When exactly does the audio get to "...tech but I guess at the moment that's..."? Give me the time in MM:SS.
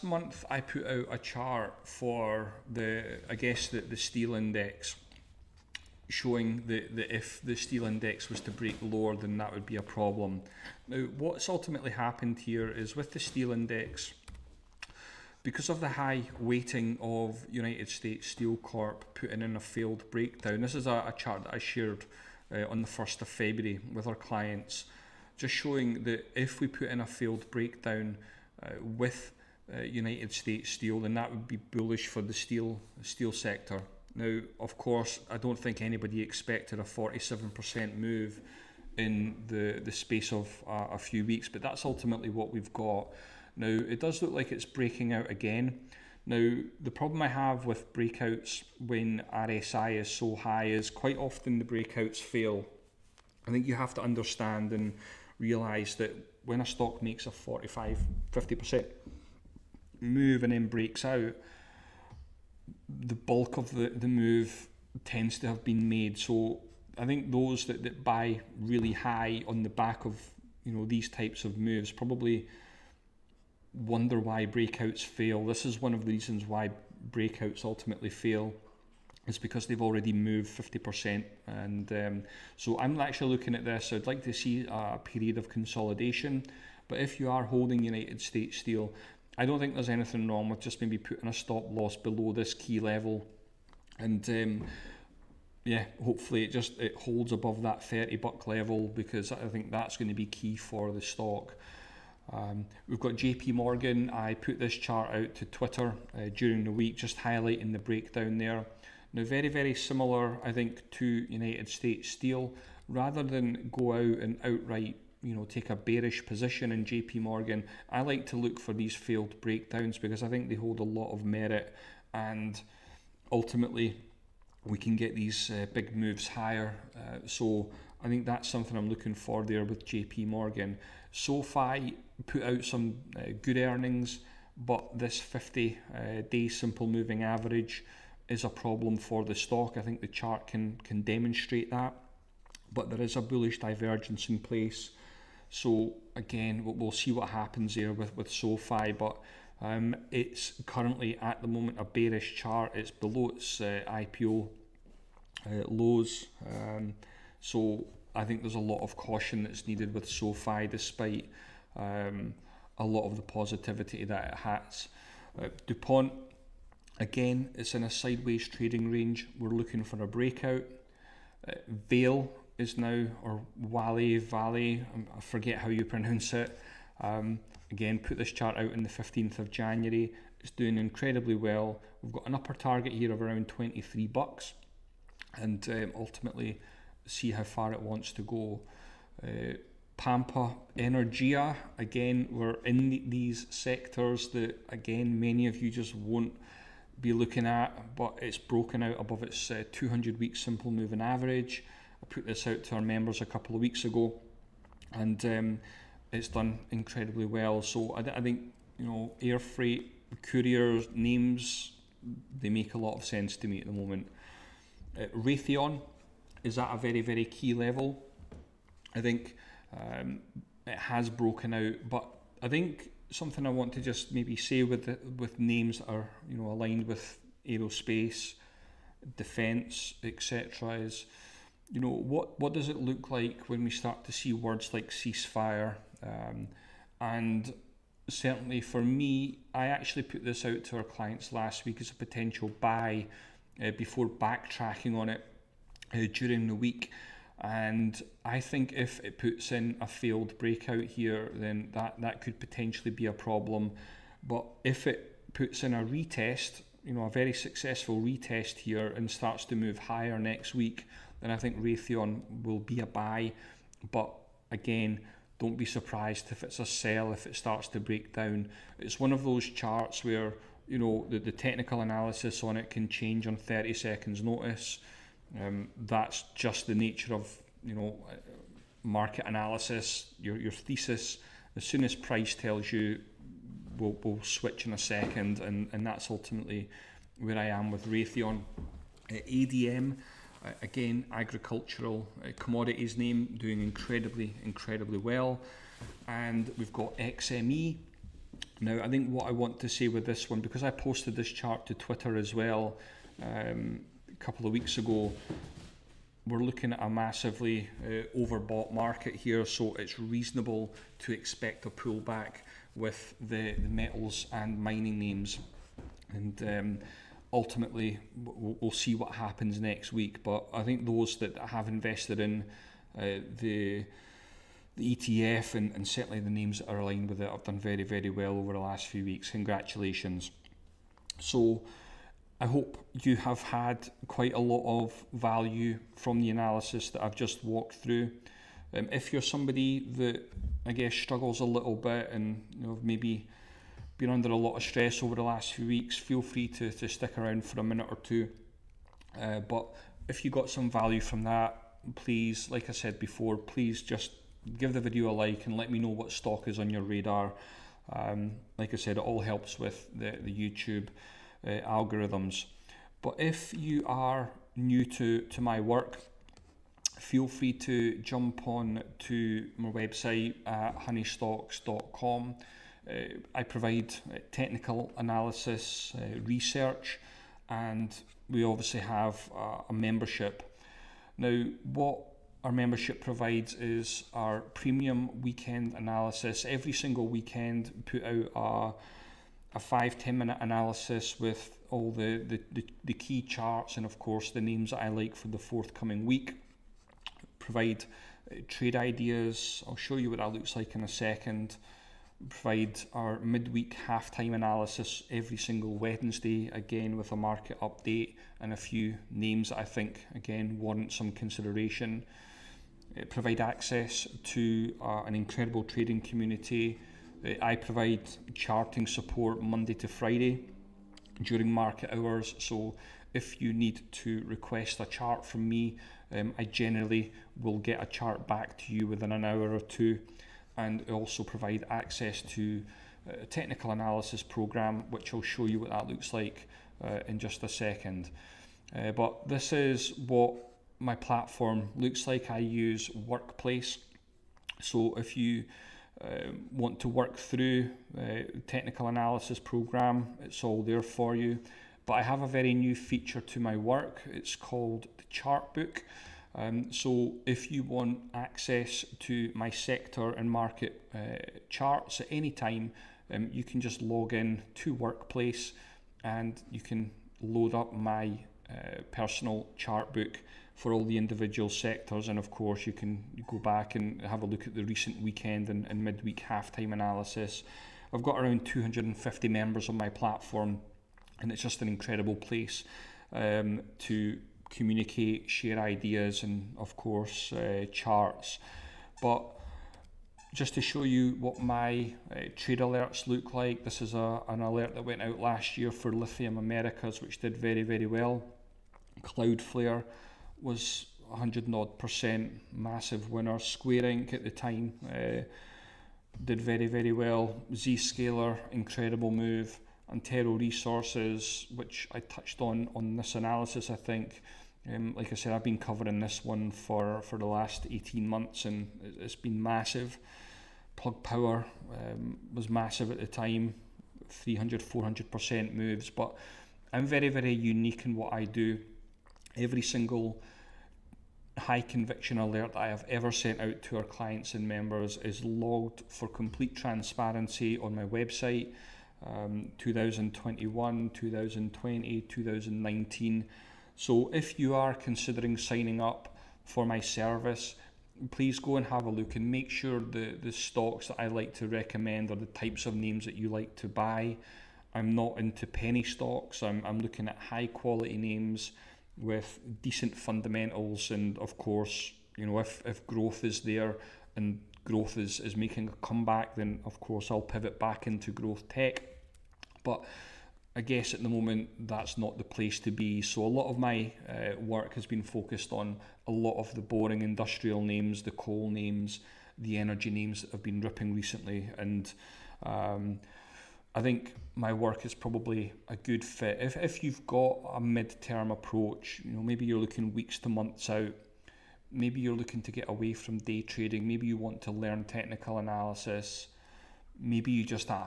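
09:28.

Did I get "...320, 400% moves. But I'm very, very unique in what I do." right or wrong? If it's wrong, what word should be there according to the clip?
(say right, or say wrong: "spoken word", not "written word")
wrong: "300", not "320".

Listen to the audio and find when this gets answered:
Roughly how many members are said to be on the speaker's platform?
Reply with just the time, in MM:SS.
07:58.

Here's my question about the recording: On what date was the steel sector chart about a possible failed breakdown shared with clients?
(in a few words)
1st of February.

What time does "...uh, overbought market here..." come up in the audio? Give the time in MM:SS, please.
05:07.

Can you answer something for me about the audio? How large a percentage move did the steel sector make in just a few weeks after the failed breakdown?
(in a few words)
47%.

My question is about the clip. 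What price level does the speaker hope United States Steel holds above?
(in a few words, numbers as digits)
$30.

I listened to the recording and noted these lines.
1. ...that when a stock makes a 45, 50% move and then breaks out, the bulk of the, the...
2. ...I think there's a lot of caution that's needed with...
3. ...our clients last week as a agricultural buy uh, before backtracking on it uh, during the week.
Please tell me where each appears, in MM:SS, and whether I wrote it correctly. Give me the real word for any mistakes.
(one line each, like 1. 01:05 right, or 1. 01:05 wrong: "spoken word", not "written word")
1. 00:55 right
2. 02:38 right
3. 04:00 wrong: "potential", not "agricultural".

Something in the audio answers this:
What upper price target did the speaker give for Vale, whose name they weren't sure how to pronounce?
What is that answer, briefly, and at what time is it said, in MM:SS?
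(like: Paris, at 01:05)
$23, at 03:03.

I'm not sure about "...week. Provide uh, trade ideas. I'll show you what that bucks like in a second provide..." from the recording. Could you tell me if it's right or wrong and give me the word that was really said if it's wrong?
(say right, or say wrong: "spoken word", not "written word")
wrong: "looks", not "bucks".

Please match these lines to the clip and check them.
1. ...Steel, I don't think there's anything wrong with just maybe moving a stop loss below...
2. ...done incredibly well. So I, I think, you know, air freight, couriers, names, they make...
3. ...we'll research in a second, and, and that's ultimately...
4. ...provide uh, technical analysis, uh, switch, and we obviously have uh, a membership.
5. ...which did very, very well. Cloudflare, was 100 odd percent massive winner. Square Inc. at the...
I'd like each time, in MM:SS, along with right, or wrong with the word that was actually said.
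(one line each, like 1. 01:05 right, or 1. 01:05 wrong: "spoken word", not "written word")
1. 01:28 wrong: "putting", not "moving"
2. 03:26 right
3. 04:44 wrong: "switch", not "research"
4. 06:13 wrong: "research", not "switch"
5. 08:17 right.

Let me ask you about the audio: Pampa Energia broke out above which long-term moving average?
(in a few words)
200 week simple moving average.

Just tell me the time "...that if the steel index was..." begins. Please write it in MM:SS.
00:06.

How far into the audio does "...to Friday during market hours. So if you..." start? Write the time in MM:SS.
06:59.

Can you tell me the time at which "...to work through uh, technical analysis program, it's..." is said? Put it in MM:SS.
07:26.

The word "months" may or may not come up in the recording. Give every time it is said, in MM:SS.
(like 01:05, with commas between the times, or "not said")
00:00, 08:38, 09:50.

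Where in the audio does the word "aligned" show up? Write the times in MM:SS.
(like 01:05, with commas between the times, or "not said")
03:46, 05:26.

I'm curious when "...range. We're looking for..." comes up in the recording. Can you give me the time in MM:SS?
02:48.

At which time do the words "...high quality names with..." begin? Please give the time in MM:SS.
09:17.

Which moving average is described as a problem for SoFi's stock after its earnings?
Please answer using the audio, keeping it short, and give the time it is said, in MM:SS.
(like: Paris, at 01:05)
50 day simple moving average, at 02:15.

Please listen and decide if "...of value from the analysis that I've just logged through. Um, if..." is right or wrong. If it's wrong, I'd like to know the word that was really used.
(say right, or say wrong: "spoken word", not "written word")
wrong: "walked", not "logged".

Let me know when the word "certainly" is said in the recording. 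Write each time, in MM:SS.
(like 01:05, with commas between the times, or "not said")
03:58, 05:25.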